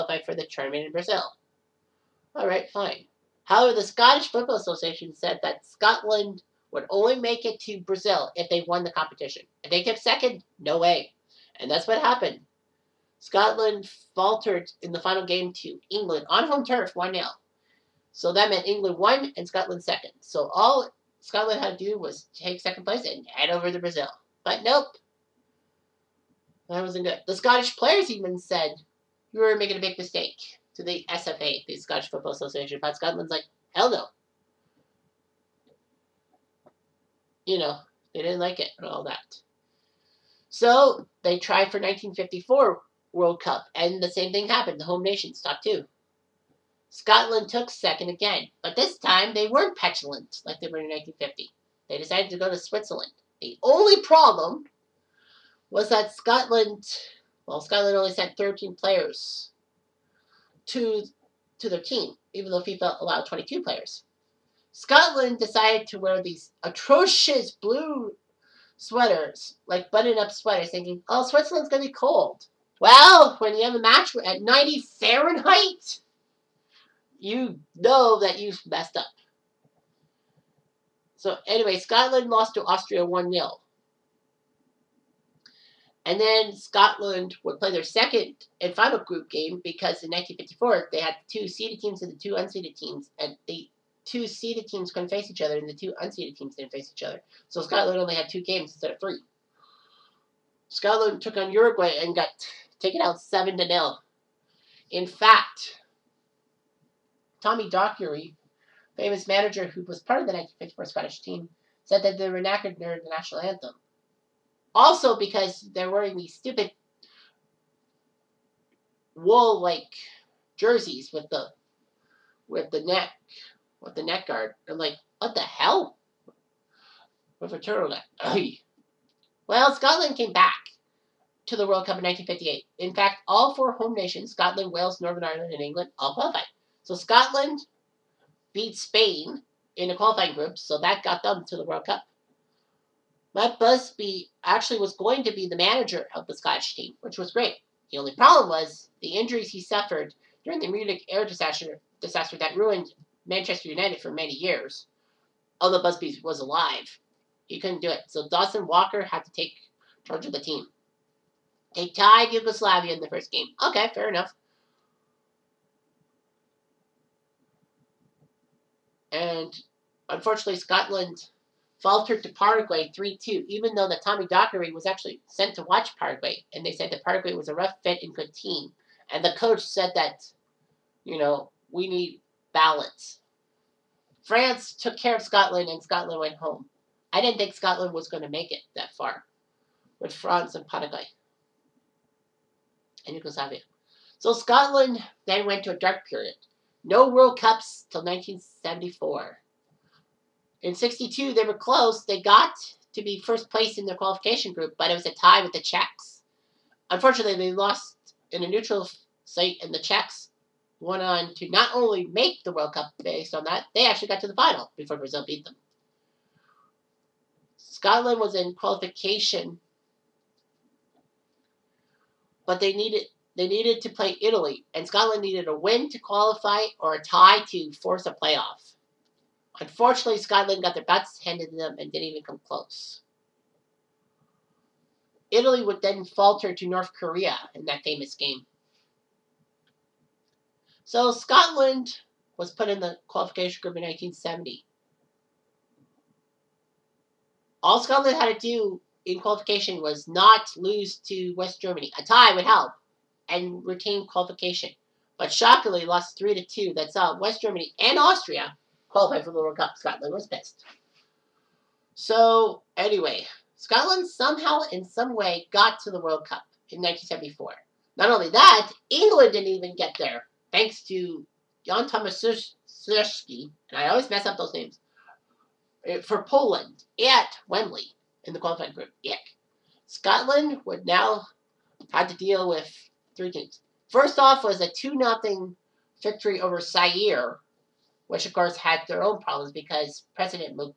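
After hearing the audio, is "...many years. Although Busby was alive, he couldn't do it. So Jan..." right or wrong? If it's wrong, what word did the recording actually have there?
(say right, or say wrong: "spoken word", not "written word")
wrong: "Dawson", not "Jan".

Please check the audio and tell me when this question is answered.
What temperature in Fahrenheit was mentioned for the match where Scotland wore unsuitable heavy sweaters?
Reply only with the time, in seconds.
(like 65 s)
74 s.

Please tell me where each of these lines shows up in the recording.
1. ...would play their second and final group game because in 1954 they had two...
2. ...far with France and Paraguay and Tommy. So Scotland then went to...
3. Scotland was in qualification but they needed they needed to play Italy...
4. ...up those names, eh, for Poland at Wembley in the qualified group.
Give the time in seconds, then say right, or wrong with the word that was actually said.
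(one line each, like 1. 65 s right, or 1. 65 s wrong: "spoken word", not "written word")
1. 87 s right
2. 188 s wrong: "Yugoslavia", not "Tommy"
3. 217 s right
4. 274 s right.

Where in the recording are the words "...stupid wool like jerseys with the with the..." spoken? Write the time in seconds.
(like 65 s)
116 s.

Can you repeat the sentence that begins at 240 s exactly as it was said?
So Scotland was put in the qualification group in 1970.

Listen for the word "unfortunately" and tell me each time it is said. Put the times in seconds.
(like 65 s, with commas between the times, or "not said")
170 s, 206 s, 229 s.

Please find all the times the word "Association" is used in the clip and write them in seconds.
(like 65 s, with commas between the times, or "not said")
4 s, 32 s.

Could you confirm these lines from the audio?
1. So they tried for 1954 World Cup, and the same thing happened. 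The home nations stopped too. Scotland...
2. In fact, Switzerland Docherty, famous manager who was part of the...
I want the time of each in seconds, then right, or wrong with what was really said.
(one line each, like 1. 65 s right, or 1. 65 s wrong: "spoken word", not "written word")
1. 40 s right
2. 104 s wrong: "Tommy", not "Switzerland".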